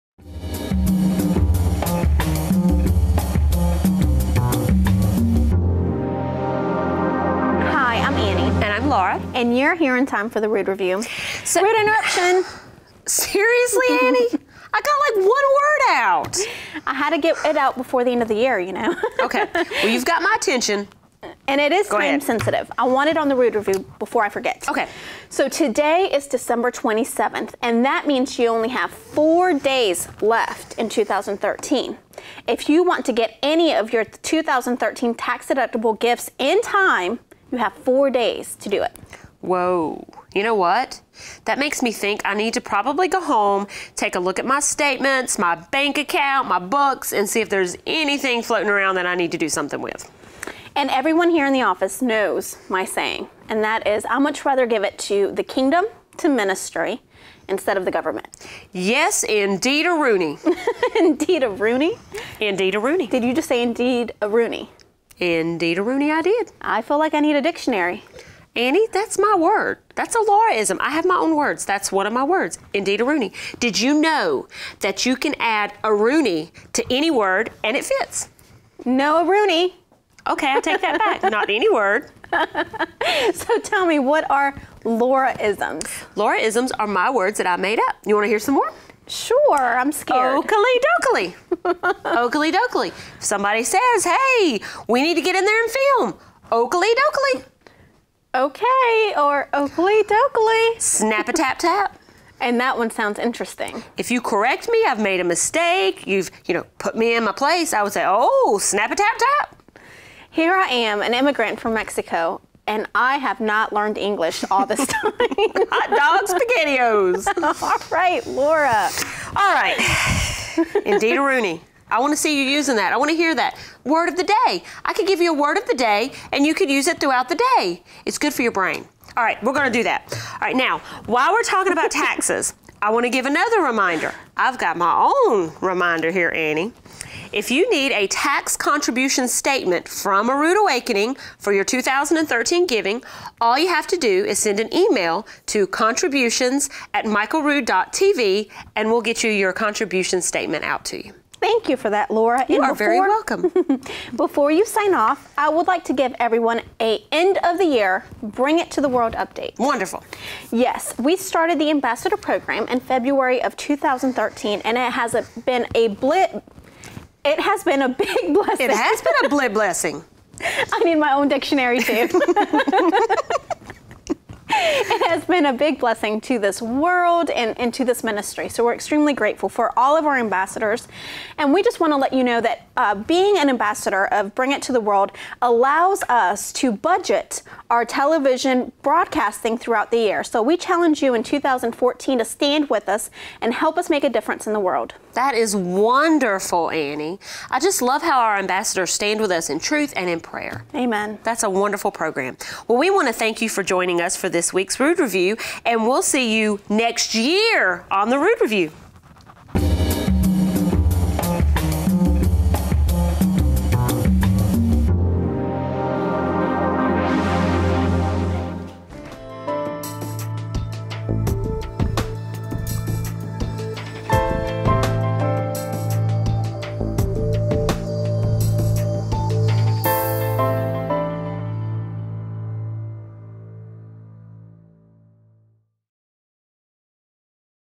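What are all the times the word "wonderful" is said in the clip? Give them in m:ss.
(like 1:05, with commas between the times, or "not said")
2:39, 3:15, 3:21.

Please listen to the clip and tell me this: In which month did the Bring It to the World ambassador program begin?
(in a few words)
February.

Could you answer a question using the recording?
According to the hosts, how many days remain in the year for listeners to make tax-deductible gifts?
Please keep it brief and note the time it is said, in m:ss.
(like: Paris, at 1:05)
4, at 0:37.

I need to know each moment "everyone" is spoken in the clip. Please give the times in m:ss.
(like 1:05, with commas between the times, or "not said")
0:50, 2:36.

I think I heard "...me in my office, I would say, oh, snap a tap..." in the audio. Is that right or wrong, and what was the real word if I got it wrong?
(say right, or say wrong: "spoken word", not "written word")
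wrong: "place", not "office".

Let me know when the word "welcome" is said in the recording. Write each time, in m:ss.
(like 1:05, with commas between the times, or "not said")
2:32.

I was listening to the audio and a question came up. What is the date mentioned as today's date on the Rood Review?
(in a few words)
December 27th.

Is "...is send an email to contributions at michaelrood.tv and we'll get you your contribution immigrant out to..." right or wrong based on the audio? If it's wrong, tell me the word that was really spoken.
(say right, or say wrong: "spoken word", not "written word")
wrong: "statement", not "immigrant".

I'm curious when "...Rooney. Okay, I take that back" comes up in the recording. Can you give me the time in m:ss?
1:19.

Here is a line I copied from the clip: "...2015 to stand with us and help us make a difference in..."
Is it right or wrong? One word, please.
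wrong.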